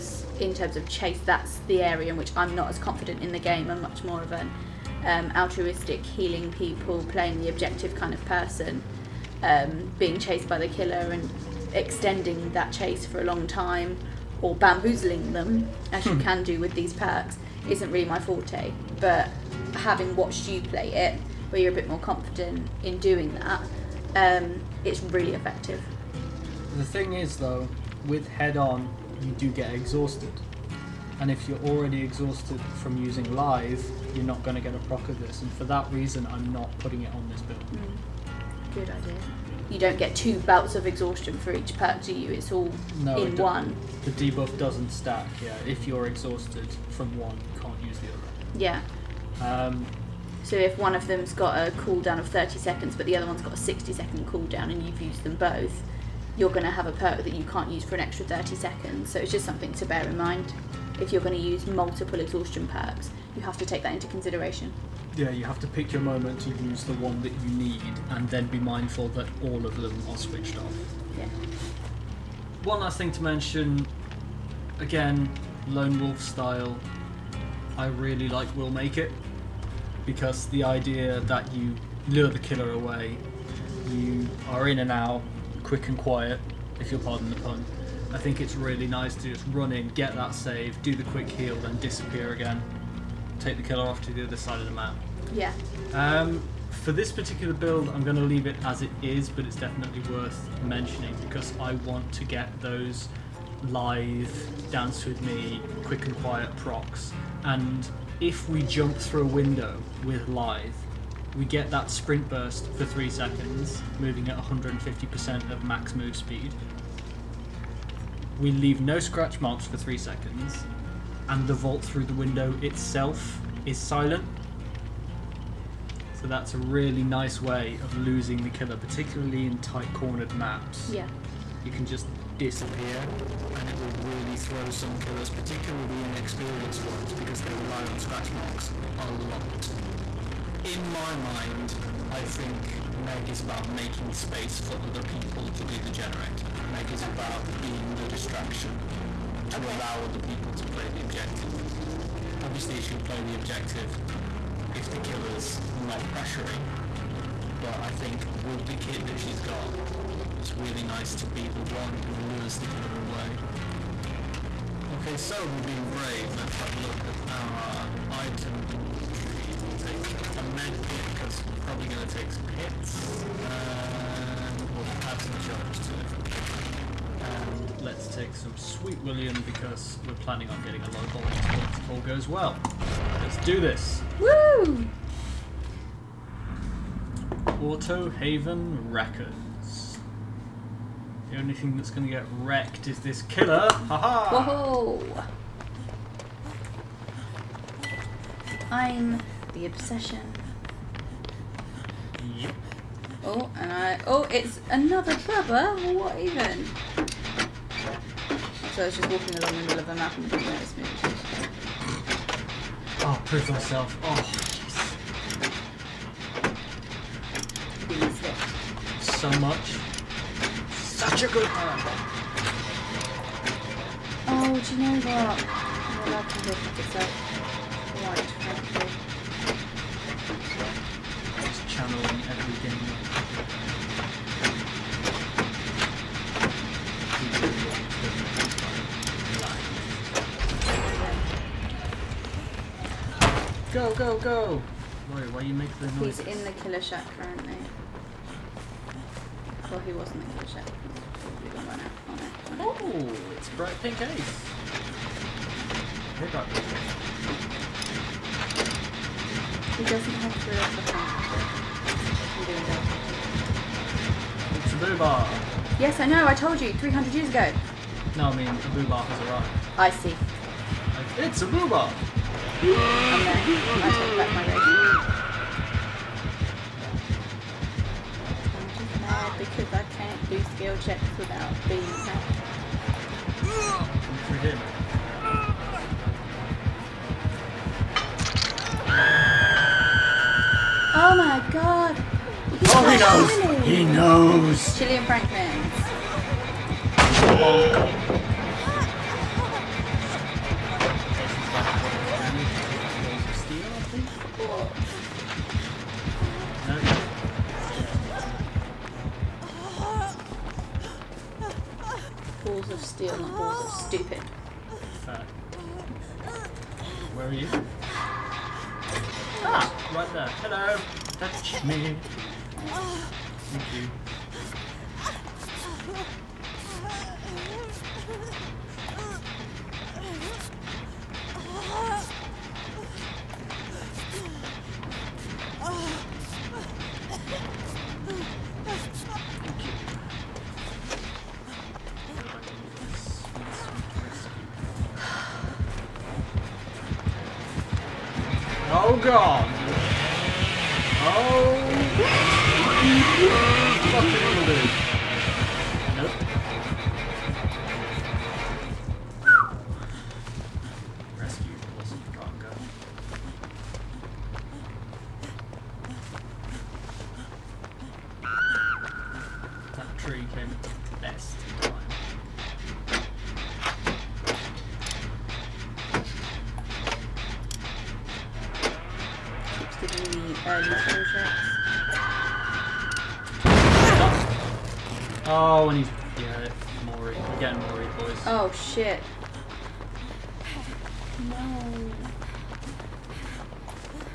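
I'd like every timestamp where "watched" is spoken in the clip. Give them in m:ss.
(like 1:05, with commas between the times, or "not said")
0:20.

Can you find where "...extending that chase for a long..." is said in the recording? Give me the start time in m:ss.
0:11.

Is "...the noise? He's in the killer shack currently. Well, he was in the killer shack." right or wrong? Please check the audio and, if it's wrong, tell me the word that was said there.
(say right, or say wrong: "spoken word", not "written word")
right.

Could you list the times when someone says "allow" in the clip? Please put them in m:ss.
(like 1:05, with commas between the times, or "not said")
2:29.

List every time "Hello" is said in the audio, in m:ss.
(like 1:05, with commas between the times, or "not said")
5:20.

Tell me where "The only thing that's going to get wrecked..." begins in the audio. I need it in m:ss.
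3:11.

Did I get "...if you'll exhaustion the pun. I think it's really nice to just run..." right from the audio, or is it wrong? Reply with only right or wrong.
wrong.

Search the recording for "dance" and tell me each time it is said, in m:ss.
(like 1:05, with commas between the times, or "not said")
1:44.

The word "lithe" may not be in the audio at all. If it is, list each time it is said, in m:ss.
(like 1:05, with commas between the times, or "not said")
0:33, 1:43, 1:50.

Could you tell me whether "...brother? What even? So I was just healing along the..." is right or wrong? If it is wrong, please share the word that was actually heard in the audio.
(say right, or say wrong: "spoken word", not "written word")
wrong: "walking", not "healing".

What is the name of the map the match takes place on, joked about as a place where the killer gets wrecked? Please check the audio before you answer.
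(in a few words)
Autohaven Wreckers.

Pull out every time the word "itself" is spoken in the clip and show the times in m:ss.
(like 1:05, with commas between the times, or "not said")
2:02.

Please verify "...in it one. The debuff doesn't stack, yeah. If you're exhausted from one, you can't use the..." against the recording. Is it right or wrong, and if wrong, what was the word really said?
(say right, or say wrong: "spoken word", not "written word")
right.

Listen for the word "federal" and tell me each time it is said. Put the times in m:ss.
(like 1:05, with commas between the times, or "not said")
not said.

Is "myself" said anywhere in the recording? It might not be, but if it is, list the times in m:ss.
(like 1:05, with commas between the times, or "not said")
3:33.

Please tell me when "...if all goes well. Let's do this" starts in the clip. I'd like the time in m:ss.
3:01.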